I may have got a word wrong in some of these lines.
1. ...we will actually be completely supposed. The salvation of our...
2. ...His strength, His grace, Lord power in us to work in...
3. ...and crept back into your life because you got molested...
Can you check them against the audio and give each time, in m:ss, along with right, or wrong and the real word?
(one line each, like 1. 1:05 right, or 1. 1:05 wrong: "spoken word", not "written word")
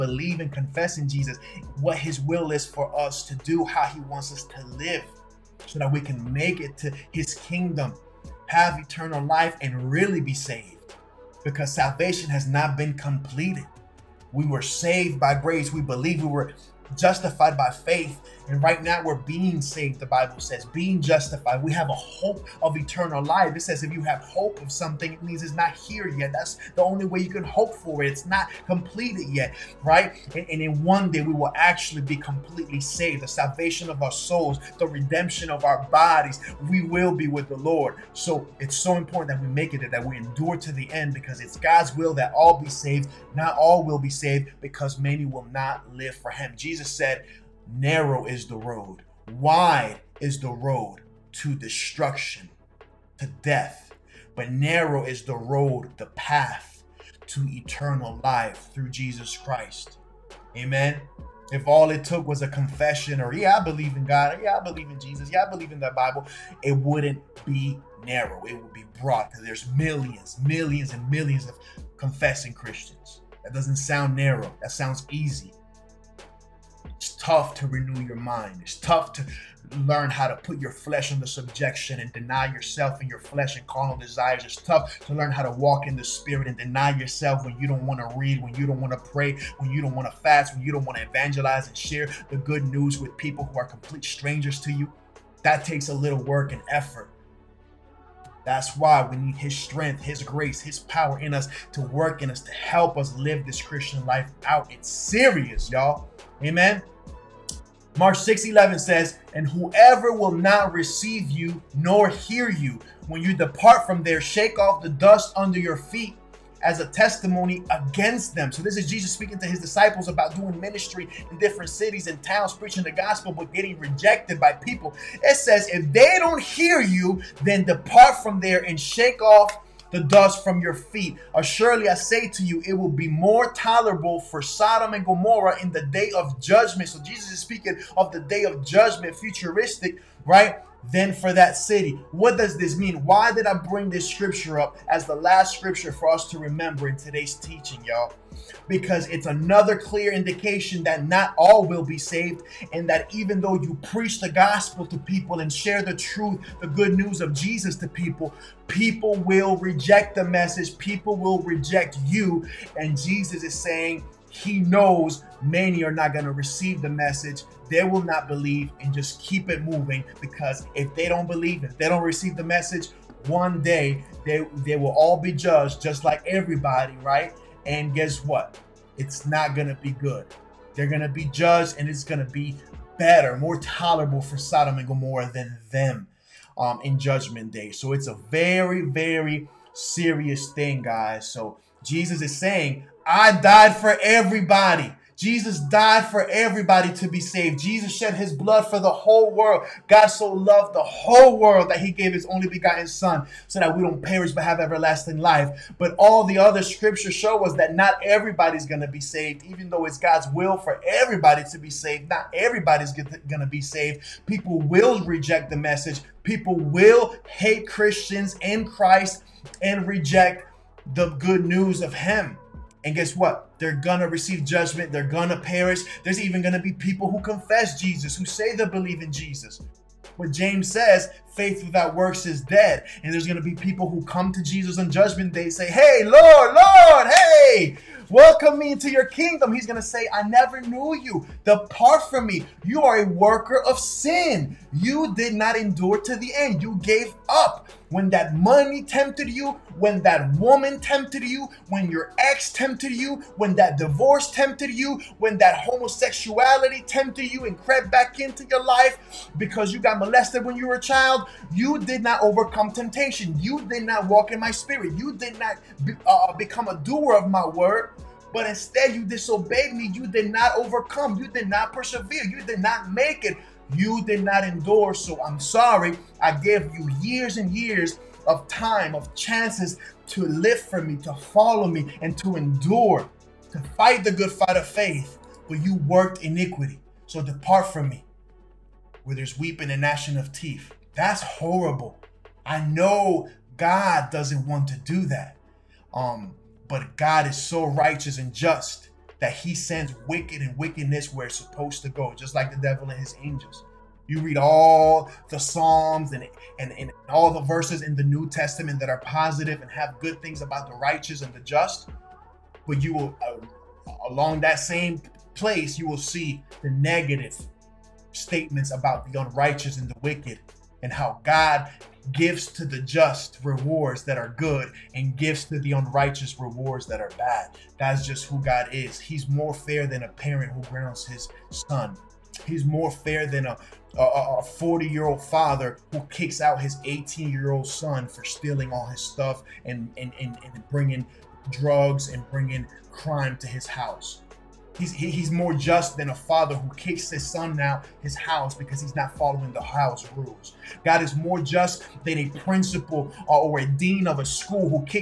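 1. 0:31 wrong: "saved", not "supposed"
2. 1:39 wrong: "His", not "Lord"
3. 4:17 right.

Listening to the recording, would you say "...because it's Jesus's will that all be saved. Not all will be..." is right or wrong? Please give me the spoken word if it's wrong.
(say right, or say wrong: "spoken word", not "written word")
wrong: "God", not "Jesus".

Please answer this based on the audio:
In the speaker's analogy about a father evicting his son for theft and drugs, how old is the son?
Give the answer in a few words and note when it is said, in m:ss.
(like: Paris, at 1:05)
18, at 5:36.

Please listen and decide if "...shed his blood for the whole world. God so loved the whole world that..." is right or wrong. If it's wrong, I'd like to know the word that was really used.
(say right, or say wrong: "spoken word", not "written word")
right.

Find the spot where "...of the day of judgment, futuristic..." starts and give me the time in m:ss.
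2:17.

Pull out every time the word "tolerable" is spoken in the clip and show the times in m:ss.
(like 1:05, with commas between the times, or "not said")
2:13, 3:03.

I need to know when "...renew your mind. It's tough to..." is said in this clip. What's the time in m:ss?
1:17.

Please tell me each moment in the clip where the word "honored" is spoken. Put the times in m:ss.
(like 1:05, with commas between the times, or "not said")
not said.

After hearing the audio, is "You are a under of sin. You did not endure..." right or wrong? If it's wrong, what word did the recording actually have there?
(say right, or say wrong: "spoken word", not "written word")
wrong: "worker", not "under".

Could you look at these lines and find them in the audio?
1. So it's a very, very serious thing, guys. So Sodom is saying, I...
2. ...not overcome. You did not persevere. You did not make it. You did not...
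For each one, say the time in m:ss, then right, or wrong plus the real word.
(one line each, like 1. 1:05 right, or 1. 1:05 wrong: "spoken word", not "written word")
1. 3:07 wrong: "Jesus", not "Sodom"
2. 4:30 right.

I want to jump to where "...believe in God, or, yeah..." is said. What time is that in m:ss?
1:03.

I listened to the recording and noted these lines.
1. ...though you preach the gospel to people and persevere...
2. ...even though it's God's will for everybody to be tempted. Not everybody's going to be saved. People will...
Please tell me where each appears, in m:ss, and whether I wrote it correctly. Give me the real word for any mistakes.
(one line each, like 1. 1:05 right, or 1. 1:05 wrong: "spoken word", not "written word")
1. 2:33 wrong: "share", not "persevere"
2. 3:29 wrong: "saved", not "tempted".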